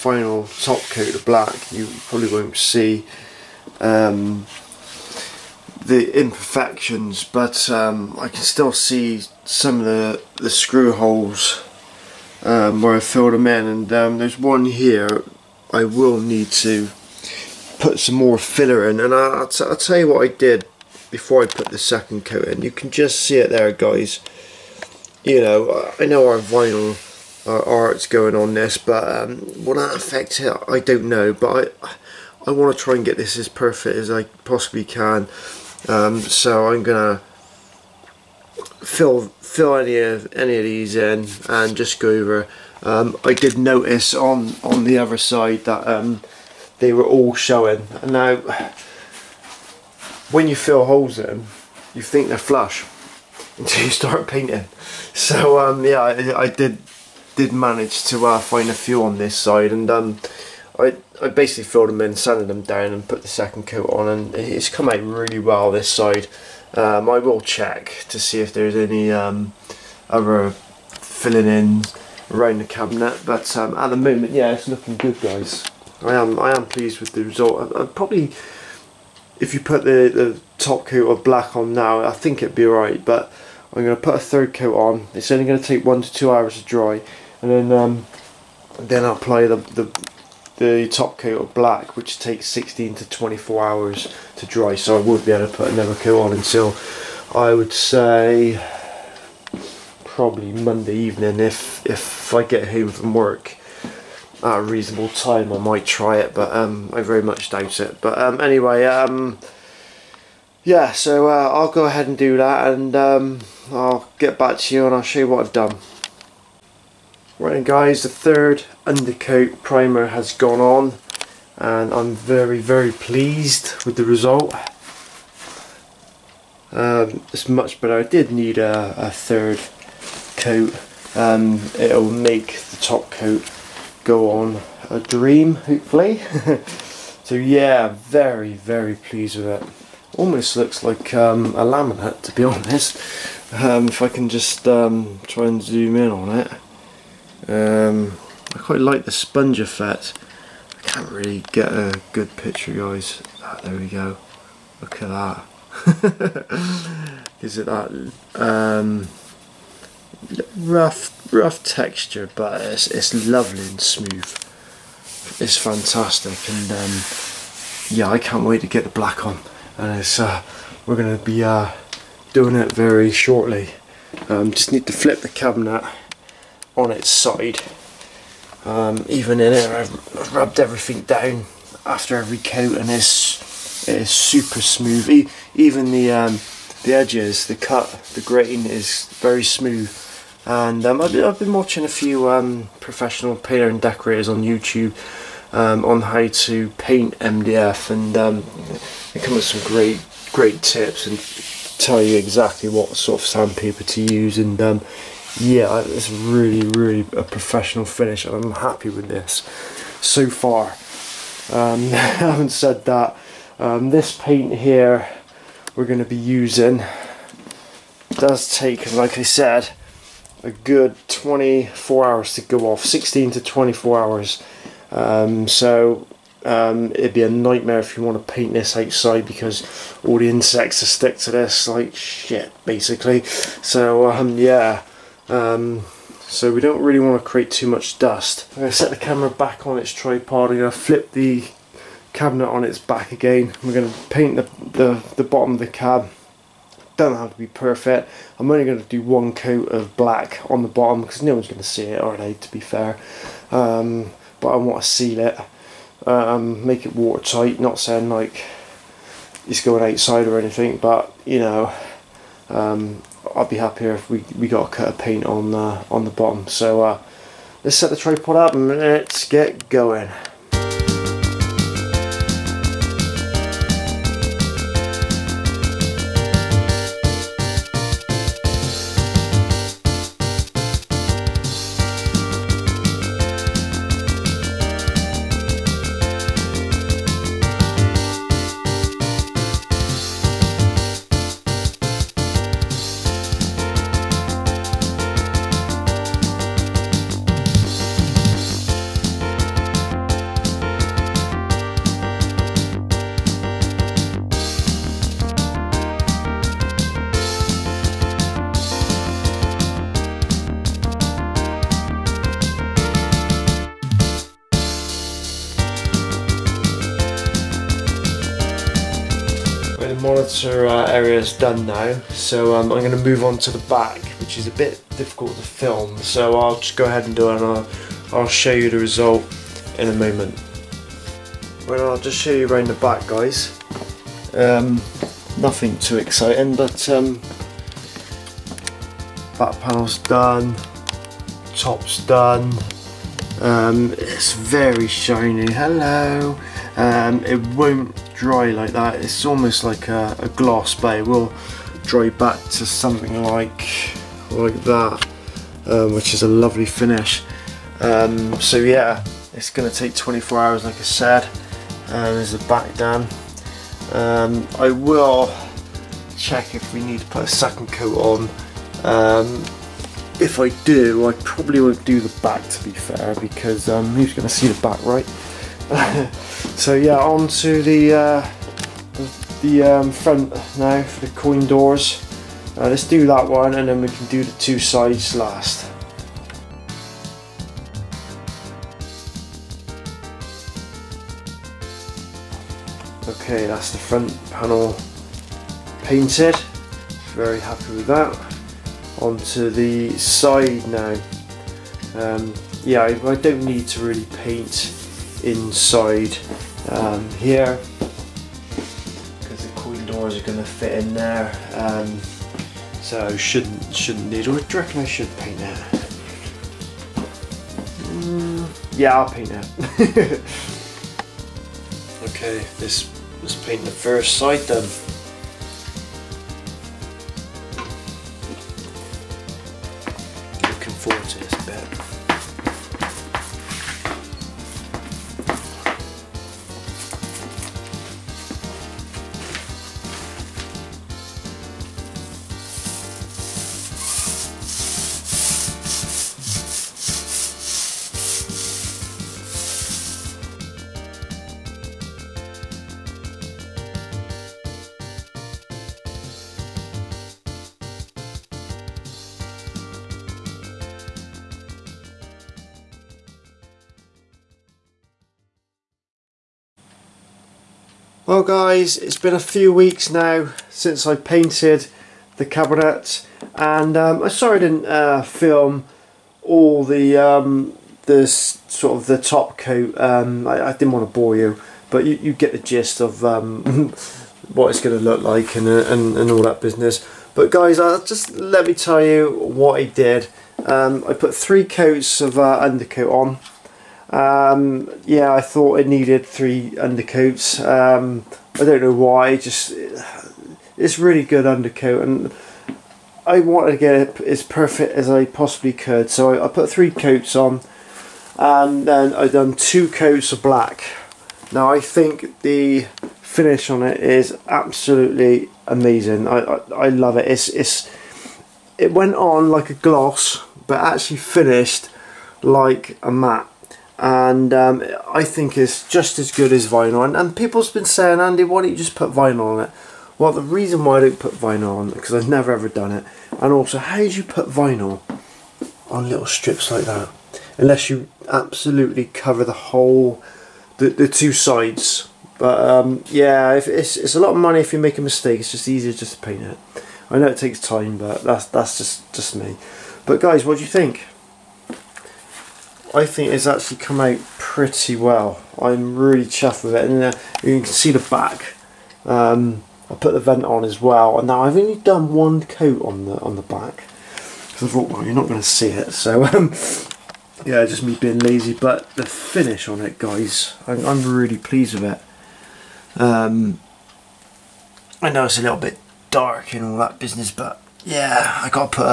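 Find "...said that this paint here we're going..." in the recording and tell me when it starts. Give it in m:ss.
3:32.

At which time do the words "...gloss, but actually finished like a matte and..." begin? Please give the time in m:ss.
8:39.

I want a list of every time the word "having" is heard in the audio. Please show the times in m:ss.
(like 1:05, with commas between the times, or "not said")
3:31.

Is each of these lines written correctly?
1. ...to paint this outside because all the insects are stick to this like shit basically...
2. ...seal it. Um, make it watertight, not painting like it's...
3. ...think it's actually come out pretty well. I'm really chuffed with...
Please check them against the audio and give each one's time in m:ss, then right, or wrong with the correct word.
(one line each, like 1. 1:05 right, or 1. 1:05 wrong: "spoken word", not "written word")
1. 3:48 right
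2. 4:14 wrong: "saying", not "painting"
3. 9:12 right.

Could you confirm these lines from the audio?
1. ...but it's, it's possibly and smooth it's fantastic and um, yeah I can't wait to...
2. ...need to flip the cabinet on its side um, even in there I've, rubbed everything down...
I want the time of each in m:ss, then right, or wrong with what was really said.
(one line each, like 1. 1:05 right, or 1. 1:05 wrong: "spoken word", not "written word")
1. 2:42 wrong: "lovely", not "possibly"
2. 2:54 right.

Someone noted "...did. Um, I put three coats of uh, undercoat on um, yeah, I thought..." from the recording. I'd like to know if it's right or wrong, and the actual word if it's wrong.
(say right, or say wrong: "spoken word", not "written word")
right.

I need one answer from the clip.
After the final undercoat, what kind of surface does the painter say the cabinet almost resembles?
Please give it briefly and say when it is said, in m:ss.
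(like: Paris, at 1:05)
A laminate, at 2:21.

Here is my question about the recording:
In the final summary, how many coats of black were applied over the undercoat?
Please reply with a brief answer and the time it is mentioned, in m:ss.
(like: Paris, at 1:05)
2, at 8:29.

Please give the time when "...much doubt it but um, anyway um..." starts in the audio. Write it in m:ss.
1:47.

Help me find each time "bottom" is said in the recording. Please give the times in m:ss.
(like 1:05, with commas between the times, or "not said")
4:05, 4:10, 4:26.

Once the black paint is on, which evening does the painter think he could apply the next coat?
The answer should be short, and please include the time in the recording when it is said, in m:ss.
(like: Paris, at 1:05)
Monday, at 1:40.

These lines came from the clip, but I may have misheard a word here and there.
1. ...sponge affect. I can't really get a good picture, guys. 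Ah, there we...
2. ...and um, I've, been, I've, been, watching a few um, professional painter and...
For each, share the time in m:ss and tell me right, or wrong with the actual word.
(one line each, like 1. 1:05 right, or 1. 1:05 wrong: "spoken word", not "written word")
1. 2:29 wrong: "effect", not "affect"
2. 3:10 right.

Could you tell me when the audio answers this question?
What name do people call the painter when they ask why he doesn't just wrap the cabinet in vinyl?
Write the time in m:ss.
8:47.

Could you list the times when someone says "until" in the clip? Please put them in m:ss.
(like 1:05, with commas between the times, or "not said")
0:53, 1:36.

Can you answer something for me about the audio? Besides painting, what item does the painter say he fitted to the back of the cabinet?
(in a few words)
The vent.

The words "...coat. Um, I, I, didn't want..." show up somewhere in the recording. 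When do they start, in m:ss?
7:59.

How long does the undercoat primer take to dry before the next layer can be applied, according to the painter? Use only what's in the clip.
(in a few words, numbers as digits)
1 to 2 hours.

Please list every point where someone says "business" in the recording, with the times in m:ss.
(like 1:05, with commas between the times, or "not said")
8:06, 9:36.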